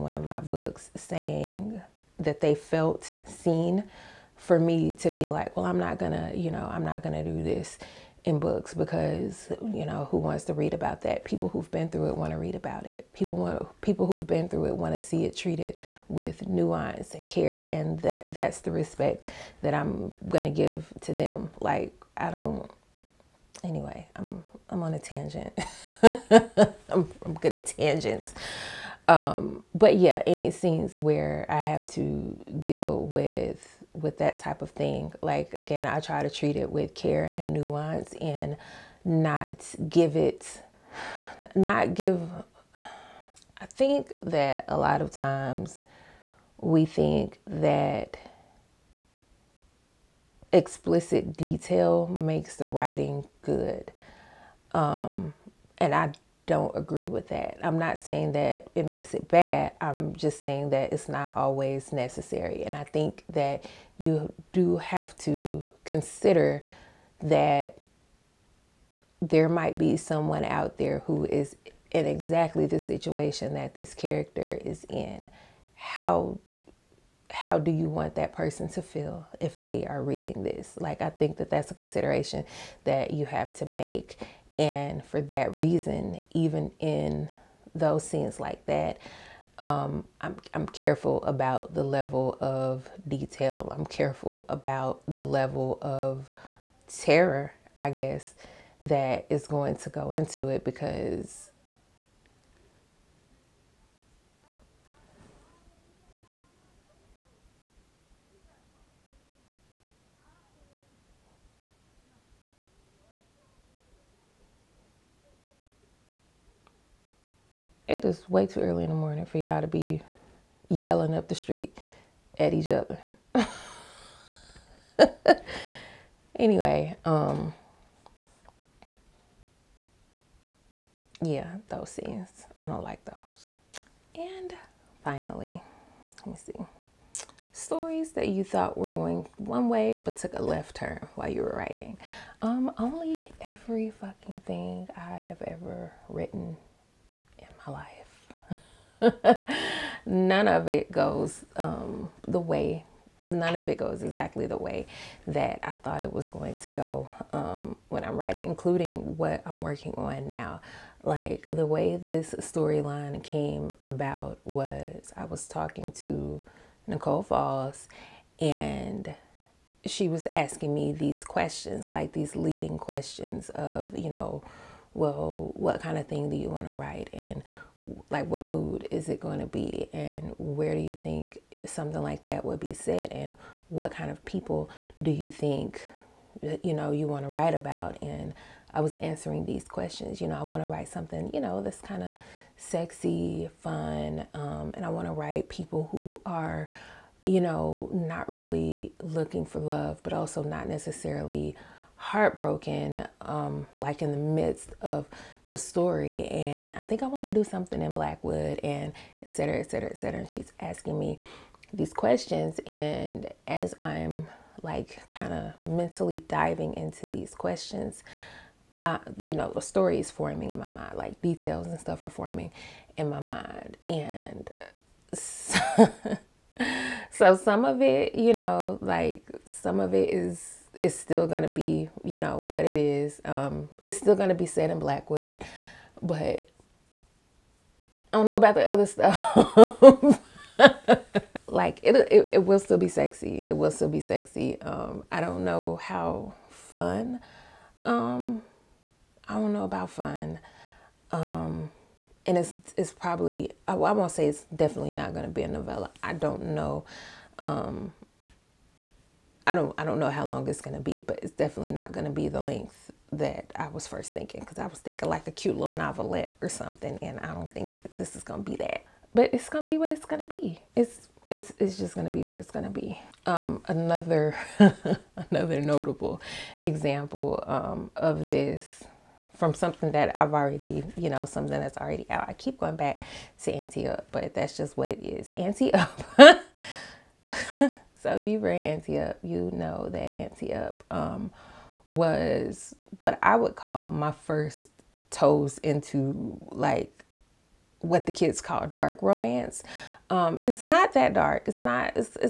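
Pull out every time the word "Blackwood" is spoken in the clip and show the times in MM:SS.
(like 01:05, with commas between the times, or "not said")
03:27, 03:54.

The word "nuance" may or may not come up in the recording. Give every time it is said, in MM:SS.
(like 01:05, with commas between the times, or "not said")
00:16, 00:37.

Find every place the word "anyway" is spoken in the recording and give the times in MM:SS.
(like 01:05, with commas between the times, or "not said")
00:23, 02:06.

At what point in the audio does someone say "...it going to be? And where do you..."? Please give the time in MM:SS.
02:59.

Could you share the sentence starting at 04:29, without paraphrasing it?
But it's gonna be what it's gonna be.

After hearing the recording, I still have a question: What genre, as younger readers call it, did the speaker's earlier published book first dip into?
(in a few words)
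dark romance.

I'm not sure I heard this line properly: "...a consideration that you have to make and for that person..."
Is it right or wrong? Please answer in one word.
wrong.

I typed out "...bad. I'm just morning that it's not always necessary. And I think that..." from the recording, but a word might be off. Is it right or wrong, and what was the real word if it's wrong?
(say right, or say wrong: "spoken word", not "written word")
wrong: "saying", not "morning".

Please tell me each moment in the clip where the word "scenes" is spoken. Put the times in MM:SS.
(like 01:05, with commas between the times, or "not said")
00:30, 01:28, 02:11.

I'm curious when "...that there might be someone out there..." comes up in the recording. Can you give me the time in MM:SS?
01:07.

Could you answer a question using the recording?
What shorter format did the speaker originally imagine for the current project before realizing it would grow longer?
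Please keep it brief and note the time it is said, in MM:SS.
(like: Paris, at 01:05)
novelette, at 04:25.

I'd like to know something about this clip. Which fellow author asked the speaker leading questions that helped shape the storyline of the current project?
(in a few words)
Nicole Falls.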